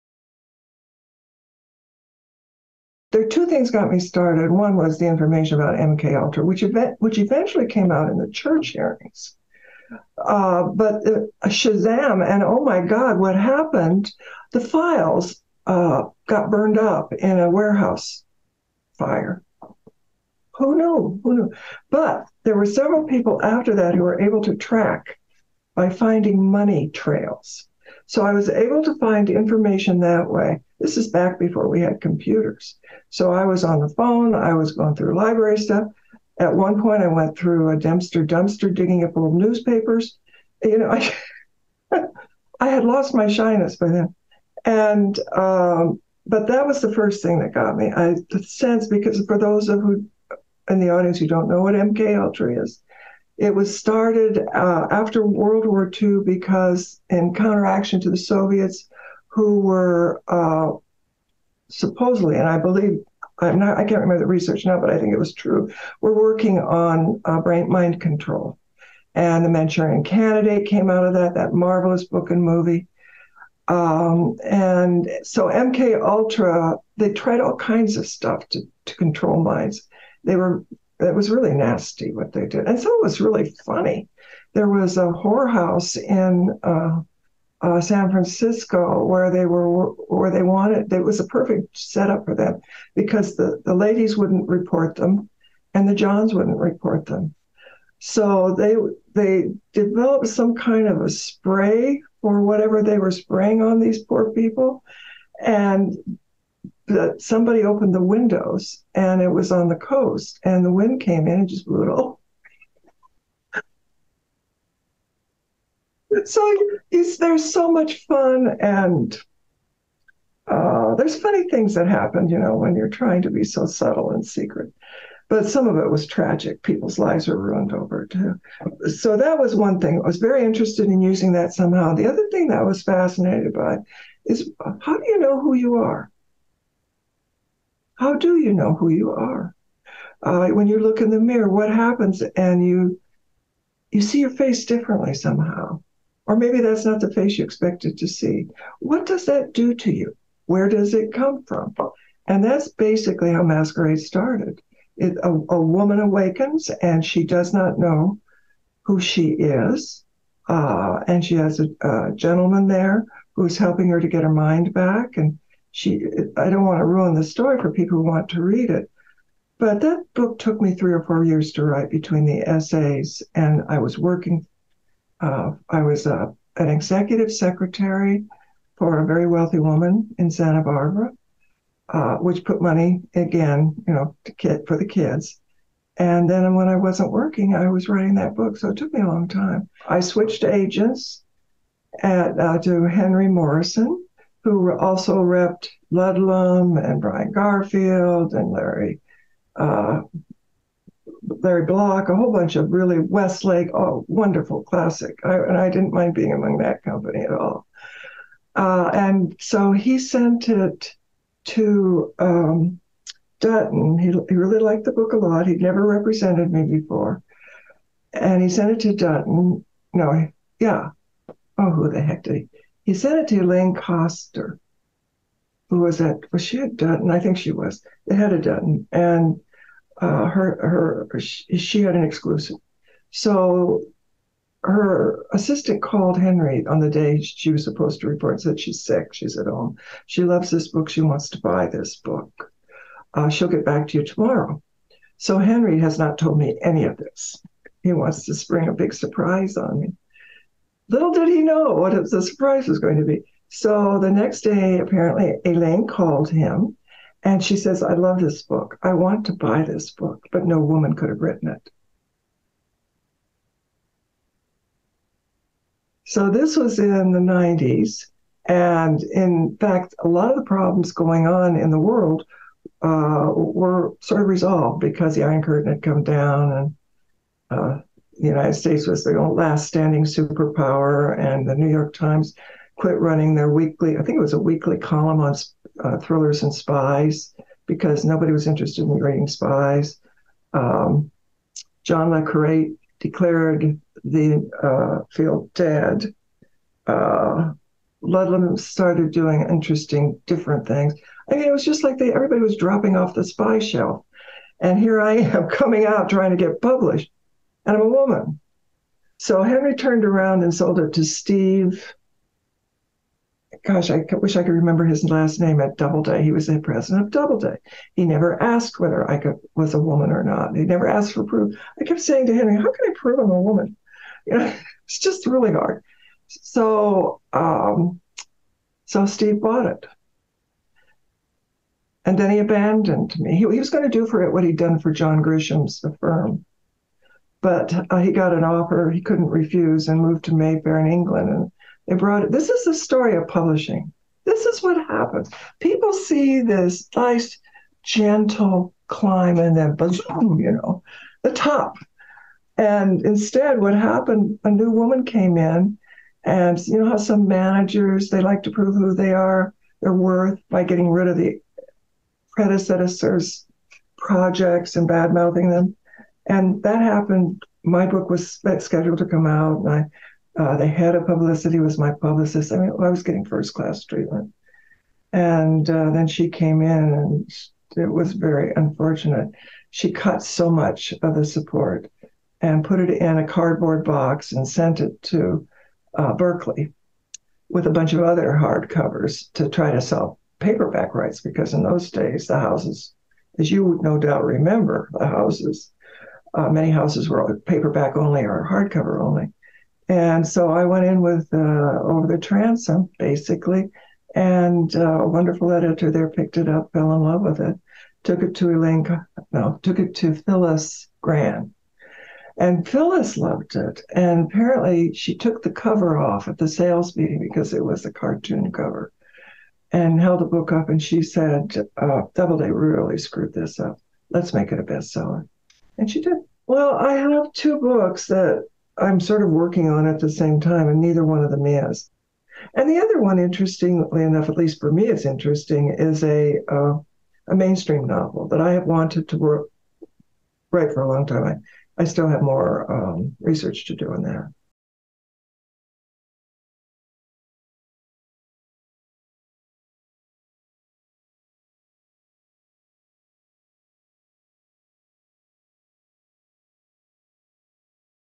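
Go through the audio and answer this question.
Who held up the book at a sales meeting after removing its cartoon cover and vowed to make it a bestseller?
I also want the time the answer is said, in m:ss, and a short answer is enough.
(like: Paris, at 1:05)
Phyllis Grann, at 6:50.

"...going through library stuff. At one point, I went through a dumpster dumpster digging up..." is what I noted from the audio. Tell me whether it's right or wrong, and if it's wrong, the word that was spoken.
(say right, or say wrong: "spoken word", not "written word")
right.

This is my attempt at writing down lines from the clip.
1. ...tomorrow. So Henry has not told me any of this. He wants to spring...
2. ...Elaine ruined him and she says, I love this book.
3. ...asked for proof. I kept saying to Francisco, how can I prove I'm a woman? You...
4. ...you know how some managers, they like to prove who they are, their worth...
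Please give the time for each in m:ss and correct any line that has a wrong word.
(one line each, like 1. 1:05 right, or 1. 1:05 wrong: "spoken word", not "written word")
1. 4:04 right
2. 4:15 wrong: "called", not "ruined"
3. 5:20 wrong: "Henry", not "Francisco"
4. 5:56 right.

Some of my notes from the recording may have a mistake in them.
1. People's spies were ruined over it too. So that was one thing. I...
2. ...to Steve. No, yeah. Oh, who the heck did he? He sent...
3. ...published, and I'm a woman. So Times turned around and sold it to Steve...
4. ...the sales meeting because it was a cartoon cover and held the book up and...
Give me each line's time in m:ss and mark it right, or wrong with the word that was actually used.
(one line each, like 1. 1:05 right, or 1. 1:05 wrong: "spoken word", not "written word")
1. 2:06 wrong: "lives", not "spies"
2. 3:38 wrong: "Dutton", not "Steve"
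3. 5:06 wrong: "Henry", not "Times"
4. 6:56 right.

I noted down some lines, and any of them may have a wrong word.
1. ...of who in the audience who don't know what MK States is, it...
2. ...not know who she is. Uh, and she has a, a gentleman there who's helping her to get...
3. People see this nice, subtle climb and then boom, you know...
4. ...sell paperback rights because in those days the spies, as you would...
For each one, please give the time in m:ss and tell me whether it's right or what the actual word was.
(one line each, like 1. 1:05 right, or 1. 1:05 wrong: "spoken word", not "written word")
1. 0:49 wrong: "Ultra", not "States"
2. 2:37 right
3. 5:45 wrong: "gentle", not "subtle"
4. 6:29 wrong: "houses", not "spies".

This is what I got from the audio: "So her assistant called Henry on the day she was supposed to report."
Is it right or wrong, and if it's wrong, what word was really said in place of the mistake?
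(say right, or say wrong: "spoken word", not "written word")
right.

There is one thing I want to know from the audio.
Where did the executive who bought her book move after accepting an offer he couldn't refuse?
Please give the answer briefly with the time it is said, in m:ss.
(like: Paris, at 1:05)
Mayfair, at 5:40.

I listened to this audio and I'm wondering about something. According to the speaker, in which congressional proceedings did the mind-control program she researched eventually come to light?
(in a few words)
Church hearings.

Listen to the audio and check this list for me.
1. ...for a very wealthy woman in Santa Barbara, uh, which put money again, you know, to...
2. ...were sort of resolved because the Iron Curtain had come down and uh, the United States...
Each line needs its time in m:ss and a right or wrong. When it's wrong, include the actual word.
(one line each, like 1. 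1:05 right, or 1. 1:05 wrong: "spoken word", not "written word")
1. 2:58 right
2. 4:33 right.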